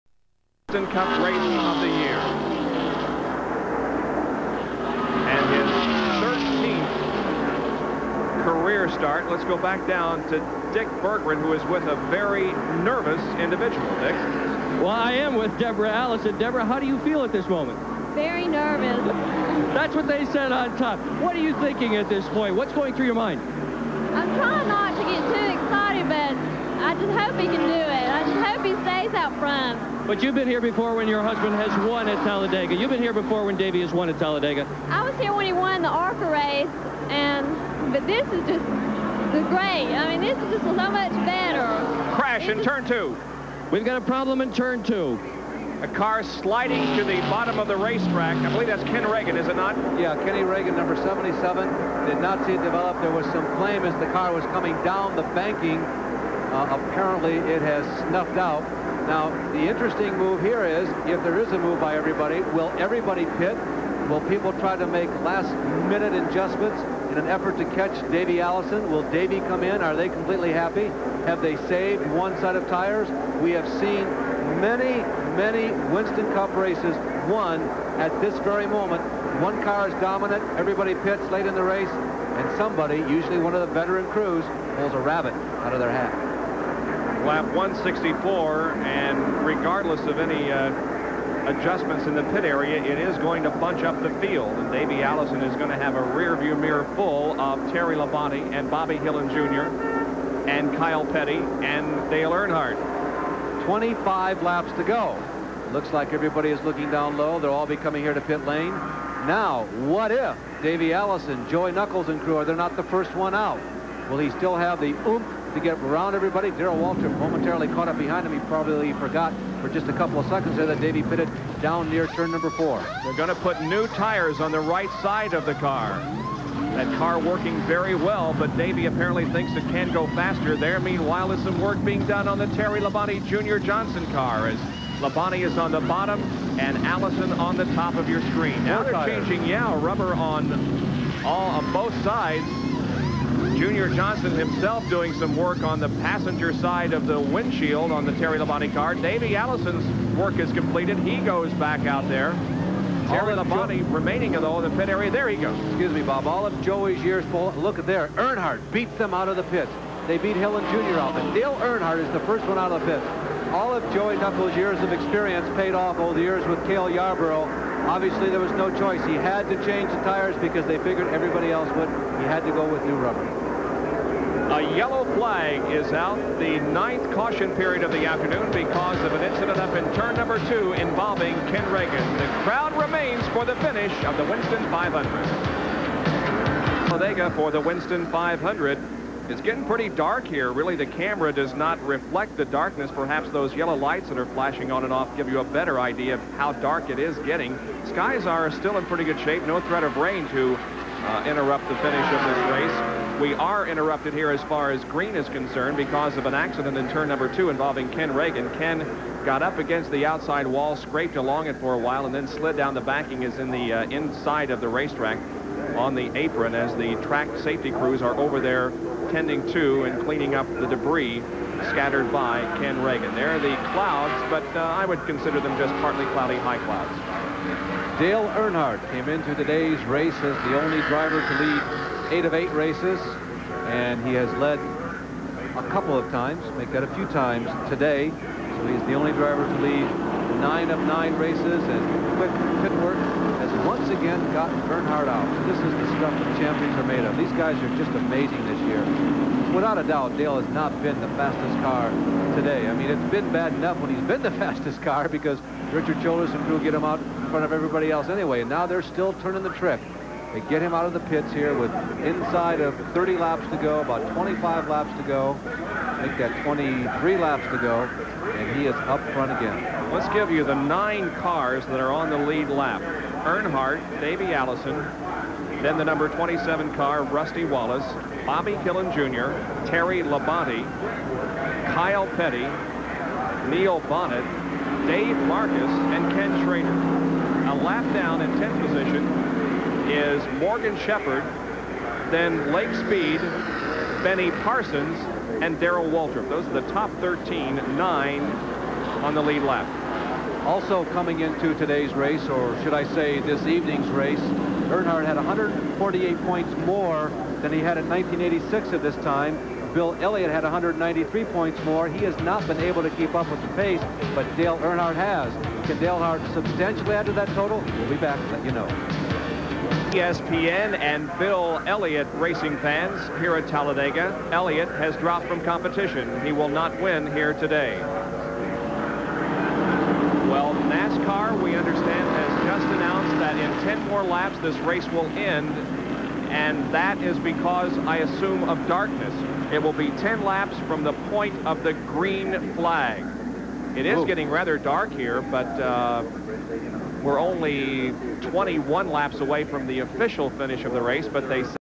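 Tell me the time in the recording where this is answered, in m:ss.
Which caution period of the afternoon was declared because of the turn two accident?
2:56.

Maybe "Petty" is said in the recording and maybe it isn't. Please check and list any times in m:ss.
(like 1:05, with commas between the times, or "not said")
1:41, 4:42.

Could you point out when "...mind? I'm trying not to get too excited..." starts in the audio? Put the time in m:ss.
0:23.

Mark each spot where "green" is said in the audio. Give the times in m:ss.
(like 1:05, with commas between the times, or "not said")
3:24, 5:41.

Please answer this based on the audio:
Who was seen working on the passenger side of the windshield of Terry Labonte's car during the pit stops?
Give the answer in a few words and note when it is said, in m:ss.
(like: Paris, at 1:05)
Junior Johnson, at 2:23.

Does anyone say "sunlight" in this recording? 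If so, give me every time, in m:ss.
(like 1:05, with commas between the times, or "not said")
not said.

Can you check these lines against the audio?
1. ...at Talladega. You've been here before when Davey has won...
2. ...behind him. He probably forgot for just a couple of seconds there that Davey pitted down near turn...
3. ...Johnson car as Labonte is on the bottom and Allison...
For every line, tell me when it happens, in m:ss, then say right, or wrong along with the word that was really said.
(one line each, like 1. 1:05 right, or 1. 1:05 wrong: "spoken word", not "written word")
1. 0:32 right
2. 1:57 right
3. 2:13 right.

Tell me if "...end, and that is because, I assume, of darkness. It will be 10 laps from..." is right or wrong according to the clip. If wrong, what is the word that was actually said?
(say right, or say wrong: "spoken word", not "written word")
right.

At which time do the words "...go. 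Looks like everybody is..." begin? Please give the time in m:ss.
1:44.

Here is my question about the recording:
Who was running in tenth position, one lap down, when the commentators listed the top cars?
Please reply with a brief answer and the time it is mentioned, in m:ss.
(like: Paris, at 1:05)
Morgan Shepherd, at 4:50.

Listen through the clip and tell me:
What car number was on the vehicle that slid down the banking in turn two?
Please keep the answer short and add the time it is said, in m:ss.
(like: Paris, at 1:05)
77, at 0:50.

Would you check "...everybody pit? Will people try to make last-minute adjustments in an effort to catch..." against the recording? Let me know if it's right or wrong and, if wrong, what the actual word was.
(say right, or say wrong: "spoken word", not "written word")
right.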